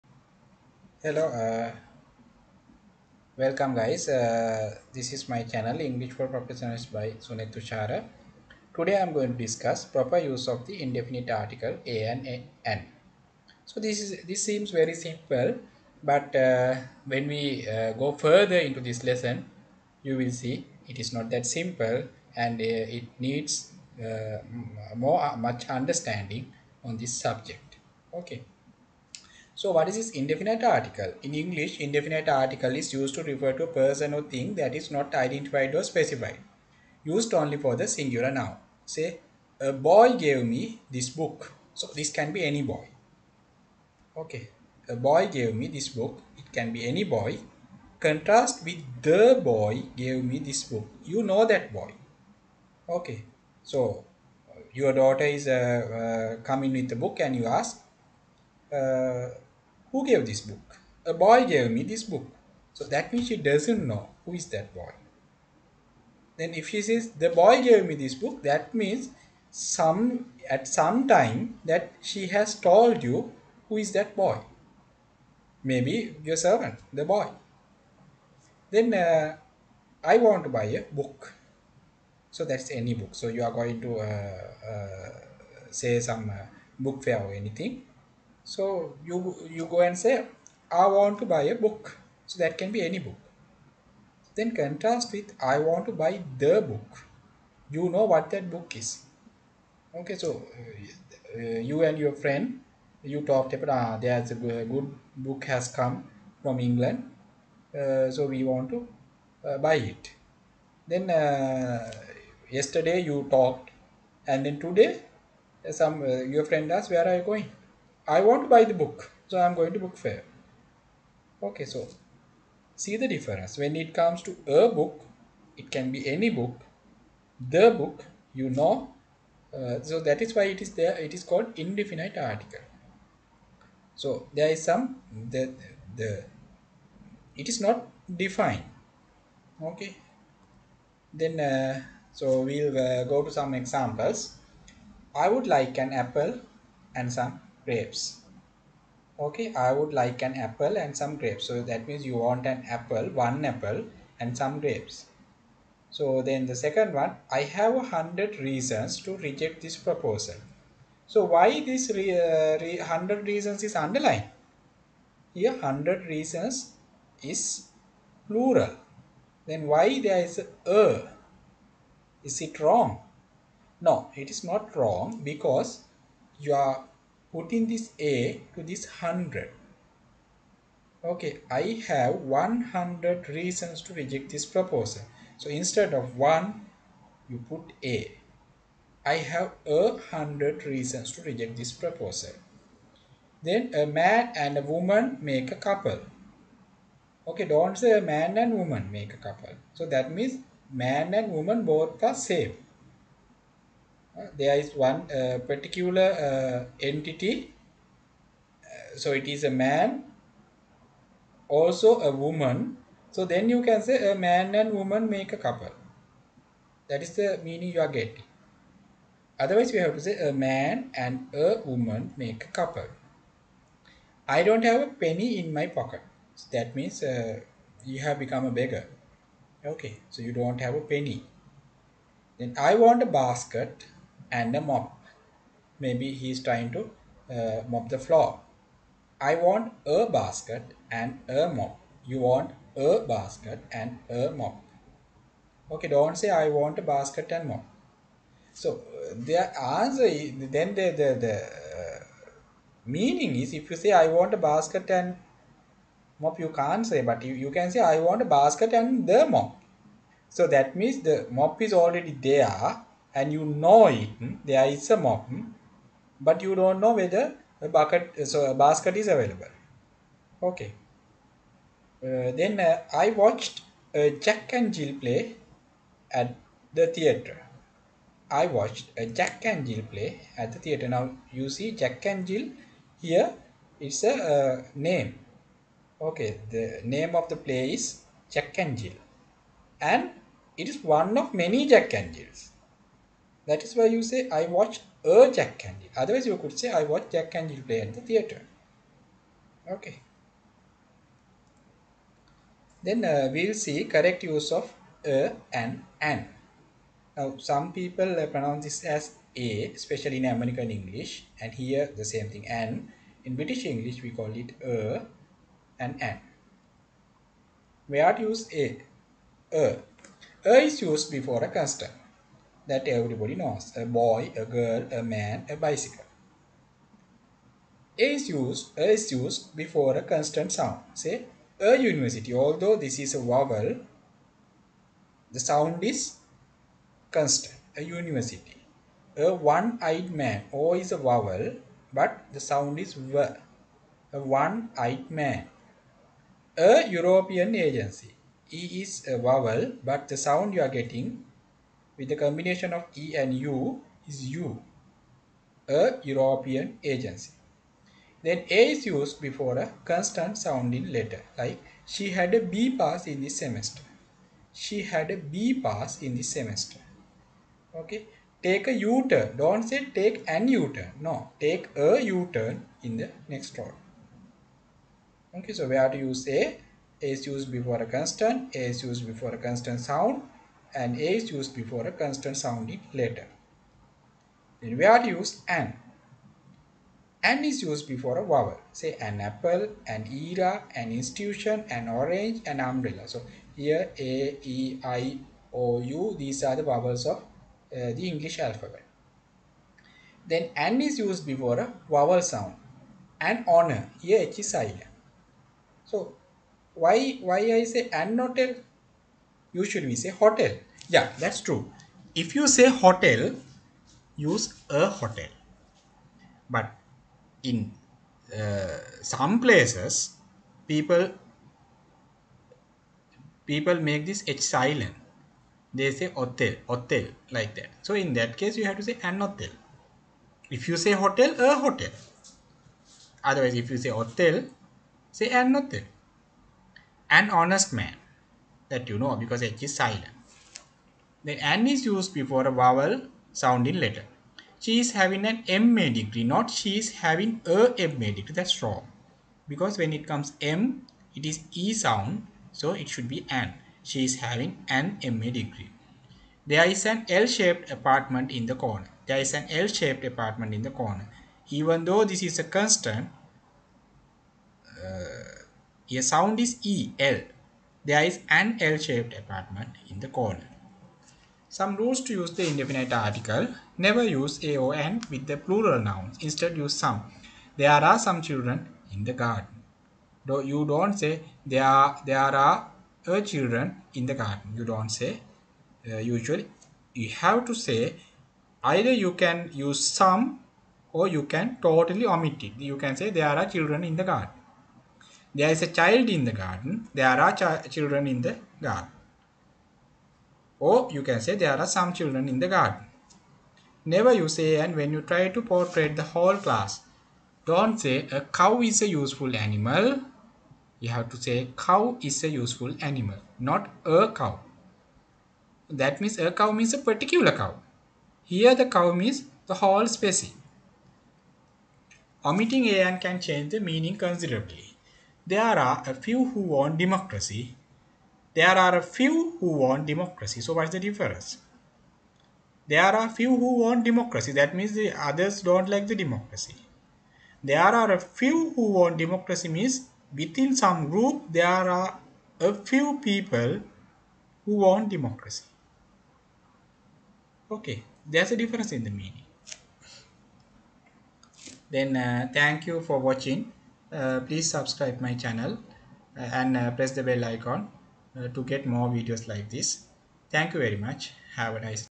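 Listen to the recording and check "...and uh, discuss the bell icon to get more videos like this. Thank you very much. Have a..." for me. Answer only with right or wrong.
wrong.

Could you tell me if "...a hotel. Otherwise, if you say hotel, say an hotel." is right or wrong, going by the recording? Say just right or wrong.
right.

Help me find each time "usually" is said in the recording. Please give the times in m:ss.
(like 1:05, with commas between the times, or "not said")
6:49, 8:05.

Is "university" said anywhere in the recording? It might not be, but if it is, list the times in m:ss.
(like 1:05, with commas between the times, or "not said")
5:31, 5:37.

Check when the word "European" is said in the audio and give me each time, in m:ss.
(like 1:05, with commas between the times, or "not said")
5:46, 5:56.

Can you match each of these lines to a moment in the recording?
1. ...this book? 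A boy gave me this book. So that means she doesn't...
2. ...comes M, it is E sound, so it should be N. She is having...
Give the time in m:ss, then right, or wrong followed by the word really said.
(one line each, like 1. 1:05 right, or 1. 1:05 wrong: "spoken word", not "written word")
1. 1:00 right
2. 7:30 right.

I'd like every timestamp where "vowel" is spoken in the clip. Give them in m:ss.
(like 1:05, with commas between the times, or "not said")
5:33, 5:40, 5:49, 6:28, 6:36, 6:41, 7:22.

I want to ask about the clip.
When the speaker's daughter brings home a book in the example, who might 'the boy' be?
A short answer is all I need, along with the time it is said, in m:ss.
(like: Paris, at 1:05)
your servant, at 1:15.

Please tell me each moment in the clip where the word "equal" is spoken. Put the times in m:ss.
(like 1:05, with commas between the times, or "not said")
not said.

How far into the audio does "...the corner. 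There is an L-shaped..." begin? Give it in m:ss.
7:38.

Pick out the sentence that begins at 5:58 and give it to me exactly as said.
Then A is used before a consonant sounding letter like she had a B pass in this semester.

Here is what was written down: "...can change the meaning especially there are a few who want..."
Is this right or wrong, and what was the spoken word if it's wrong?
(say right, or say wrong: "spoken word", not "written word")
wrong: "considerably", not "especially".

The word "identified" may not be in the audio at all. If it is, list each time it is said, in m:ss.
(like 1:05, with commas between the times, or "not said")
0:35.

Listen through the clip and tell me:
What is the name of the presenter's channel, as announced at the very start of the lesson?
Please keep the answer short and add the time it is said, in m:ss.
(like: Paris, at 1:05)
English for Professionals, at 0:05.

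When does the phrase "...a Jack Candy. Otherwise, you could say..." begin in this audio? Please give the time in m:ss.
4:55.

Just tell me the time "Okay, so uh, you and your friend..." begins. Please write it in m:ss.
1:39.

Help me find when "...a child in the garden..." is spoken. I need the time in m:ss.
8:15.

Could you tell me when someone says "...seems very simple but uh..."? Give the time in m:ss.
0:14.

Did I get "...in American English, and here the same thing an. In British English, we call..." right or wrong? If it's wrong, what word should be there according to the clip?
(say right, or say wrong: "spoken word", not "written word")
right.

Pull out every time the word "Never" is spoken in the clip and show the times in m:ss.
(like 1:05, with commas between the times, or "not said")
7:53, 8:23.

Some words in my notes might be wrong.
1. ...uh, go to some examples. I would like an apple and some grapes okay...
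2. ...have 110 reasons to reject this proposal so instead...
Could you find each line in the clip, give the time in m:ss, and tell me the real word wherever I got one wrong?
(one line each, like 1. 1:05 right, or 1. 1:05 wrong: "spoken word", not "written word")
1. 2:22 right
2. 3:01 wrong: "100", not "110".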